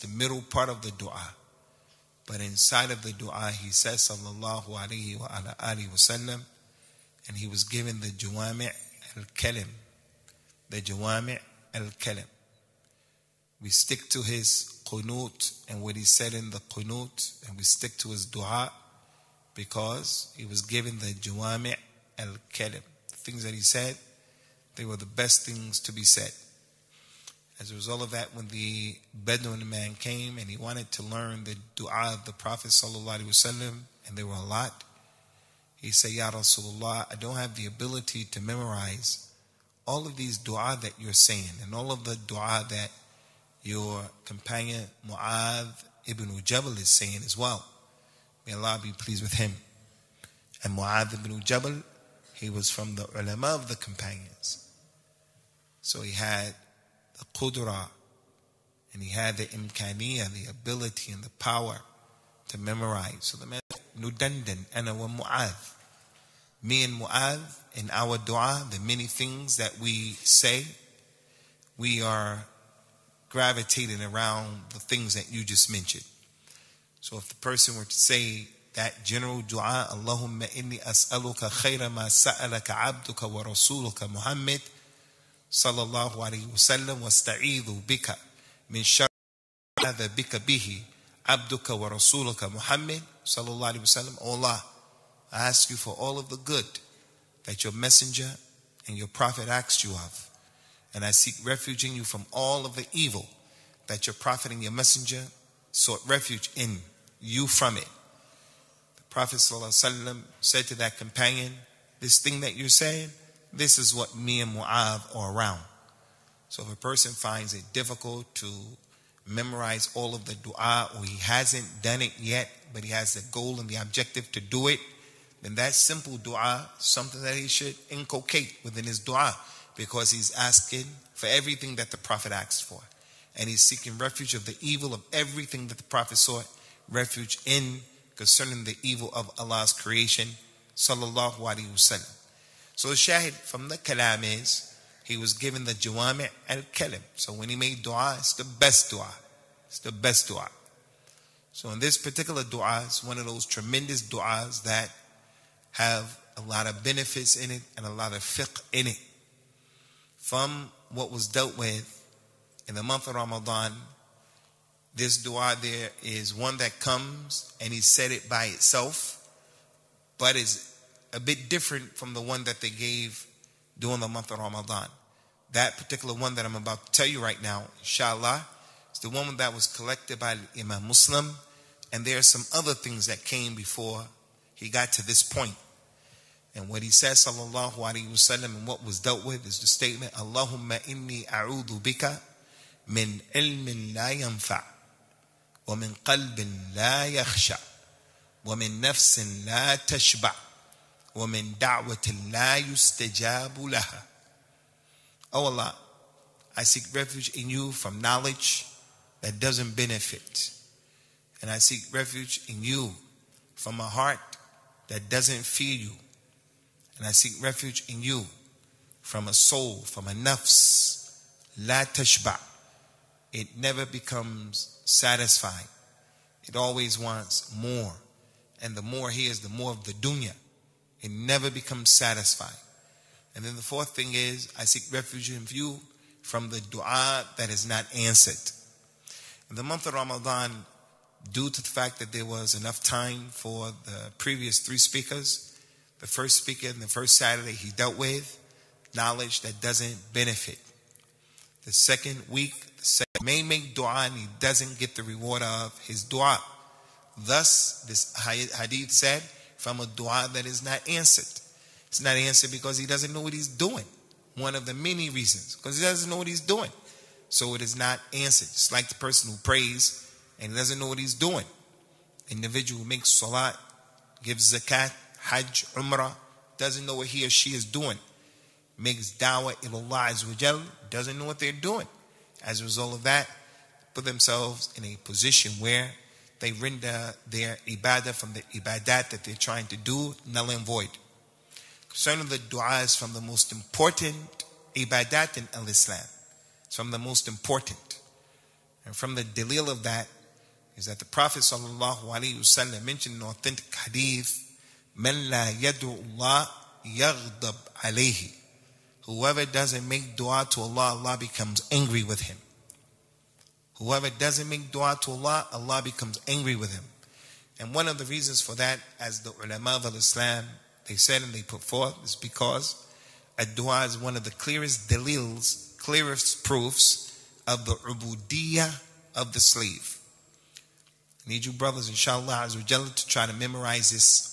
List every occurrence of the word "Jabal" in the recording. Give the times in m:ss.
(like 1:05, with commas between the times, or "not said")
0:46, 0:51.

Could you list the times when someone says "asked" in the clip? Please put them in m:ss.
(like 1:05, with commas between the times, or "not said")
1:39, 2:12.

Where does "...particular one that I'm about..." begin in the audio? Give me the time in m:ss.
2:55.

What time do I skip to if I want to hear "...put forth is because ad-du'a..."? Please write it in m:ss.
5:21.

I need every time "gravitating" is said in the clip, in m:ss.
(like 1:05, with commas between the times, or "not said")
1:13.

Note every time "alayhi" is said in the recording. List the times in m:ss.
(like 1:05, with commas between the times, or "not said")
1:26, 3:07.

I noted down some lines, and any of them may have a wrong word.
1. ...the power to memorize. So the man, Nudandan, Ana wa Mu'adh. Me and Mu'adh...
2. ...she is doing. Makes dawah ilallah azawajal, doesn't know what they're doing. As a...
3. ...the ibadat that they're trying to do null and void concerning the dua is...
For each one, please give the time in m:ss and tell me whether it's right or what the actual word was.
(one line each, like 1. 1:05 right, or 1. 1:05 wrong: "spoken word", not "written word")
1. 1:01 right
2. 4:37 wrong: "azwajal", not "azawajal"
3. 4:48 right.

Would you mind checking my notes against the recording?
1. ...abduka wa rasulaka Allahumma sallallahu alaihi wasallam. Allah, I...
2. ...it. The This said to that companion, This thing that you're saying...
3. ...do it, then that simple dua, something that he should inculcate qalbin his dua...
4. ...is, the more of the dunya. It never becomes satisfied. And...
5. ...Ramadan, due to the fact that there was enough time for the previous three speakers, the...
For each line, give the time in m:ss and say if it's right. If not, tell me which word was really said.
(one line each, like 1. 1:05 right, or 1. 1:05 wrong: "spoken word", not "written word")
1. 1:31 wrong: "Muhammad", not "Allahumma"
2. 1:47 wrong: "Prophet", not "This"
3. 2:04 wrong: "within", not "qalbin"
4. 3:49 right
5. 3:59 right.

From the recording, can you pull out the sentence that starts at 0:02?
But inside of the dua, he says, sallallahu alaihi wasallam and he was given the Jawami' al Kalim.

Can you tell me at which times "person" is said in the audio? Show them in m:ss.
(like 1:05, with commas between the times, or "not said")
1:17, 1:56, 4:28.